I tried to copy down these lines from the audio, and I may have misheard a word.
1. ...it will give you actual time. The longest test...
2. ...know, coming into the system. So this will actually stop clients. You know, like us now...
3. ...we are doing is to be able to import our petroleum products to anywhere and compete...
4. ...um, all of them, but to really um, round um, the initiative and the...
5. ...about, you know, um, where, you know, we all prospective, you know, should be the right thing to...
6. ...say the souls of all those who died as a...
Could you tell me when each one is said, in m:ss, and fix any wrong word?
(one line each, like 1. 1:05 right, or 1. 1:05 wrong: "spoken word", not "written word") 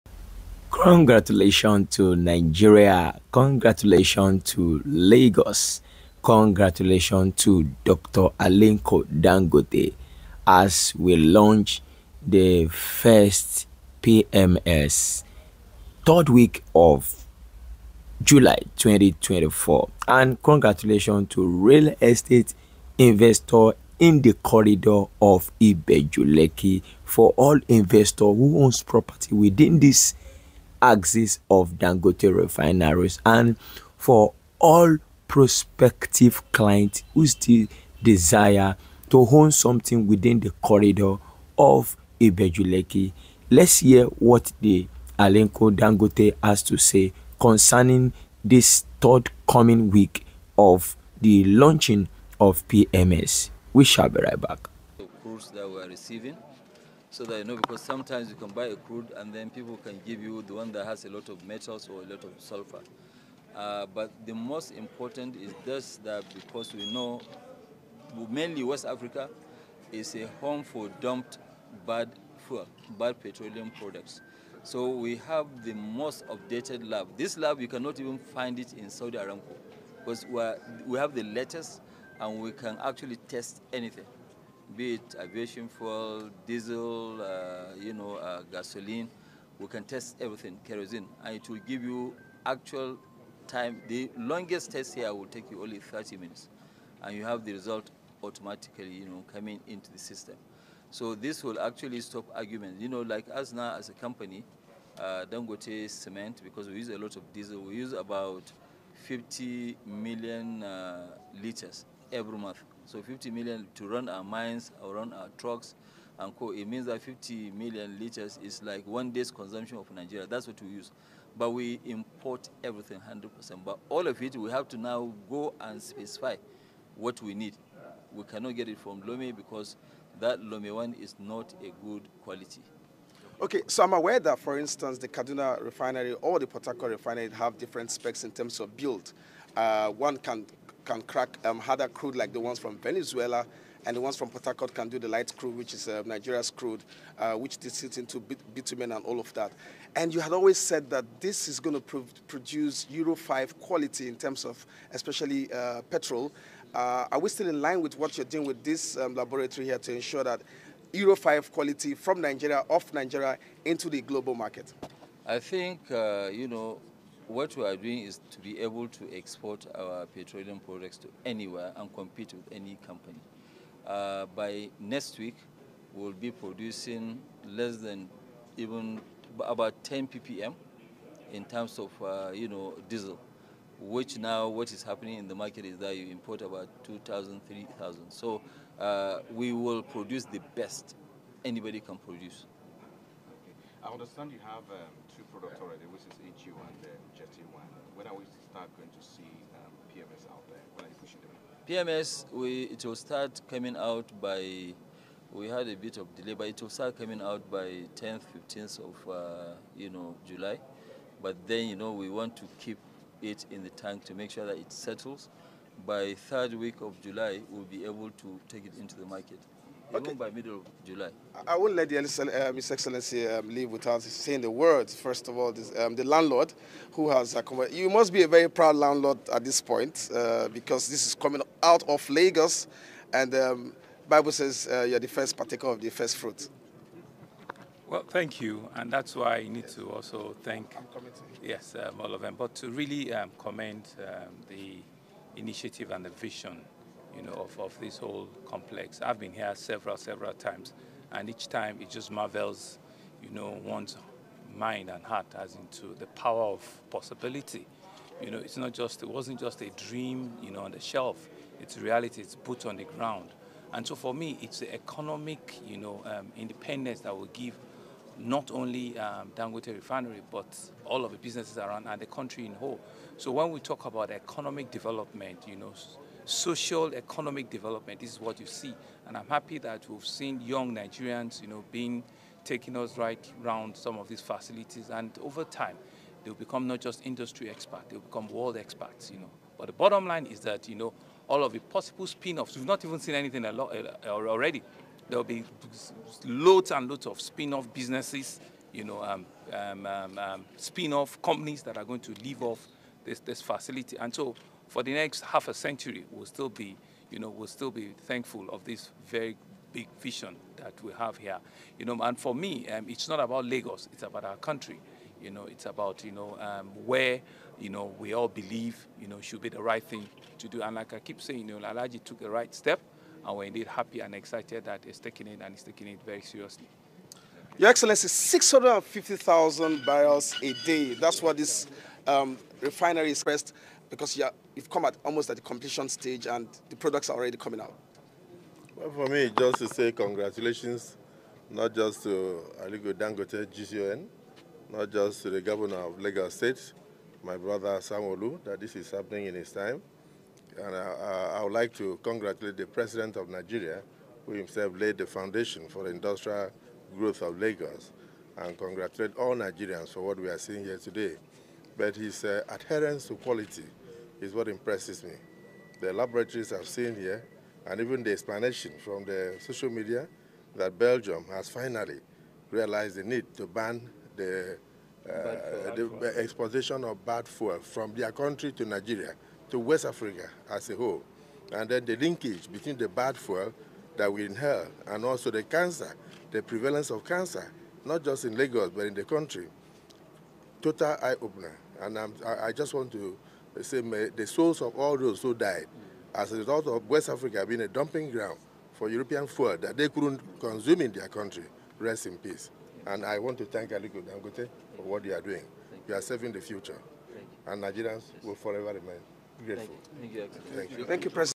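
1. 1:31 right
2. 1:39 wrong: "arguments", not "clients"
3. 2:47 wrong: "export", not "import"
4. 4:01 wrong: "commend", not "round"
5. 5:15 wrong: "believe", not "prospective"
6. 6:33 right.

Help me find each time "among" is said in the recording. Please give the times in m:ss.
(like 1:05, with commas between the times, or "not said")
not said.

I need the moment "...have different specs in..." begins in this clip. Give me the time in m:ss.
2:17.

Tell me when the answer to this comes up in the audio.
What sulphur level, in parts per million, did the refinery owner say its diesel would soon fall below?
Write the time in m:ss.
2:59.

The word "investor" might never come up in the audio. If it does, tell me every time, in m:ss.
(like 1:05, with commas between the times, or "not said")
0:22, 0:27.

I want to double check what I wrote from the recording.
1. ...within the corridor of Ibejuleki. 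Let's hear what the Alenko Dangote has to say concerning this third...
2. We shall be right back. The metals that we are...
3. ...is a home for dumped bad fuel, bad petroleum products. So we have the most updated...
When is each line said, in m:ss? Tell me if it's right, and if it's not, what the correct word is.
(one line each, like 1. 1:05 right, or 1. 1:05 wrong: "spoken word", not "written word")
1. 0:40 right
2. 0:53 wrong: "calls", not "metals"
3. 1:09 right.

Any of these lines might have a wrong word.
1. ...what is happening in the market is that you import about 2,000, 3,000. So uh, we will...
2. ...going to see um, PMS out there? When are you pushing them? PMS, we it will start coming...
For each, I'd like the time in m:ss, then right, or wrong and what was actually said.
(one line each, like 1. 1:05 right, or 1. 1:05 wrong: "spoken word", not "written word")
1. 3:04 right
2. 3:18 right.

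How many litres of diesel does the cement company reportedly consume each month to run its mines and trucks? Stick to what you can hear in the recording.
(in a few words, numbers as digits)
50 million.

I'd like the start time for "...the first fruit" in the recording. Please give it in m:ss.
3:55.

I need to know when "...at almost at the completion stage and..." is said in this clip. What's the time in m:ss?
5:34.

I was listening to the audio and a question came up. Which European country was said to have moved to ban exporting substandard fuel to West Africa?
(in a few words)
Belgium.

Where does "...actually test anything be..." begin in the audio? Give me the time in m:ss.
1:22.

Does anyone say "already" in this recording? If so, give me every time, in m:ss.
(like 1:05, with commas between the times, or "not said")
3:15, 4:54, 5:37.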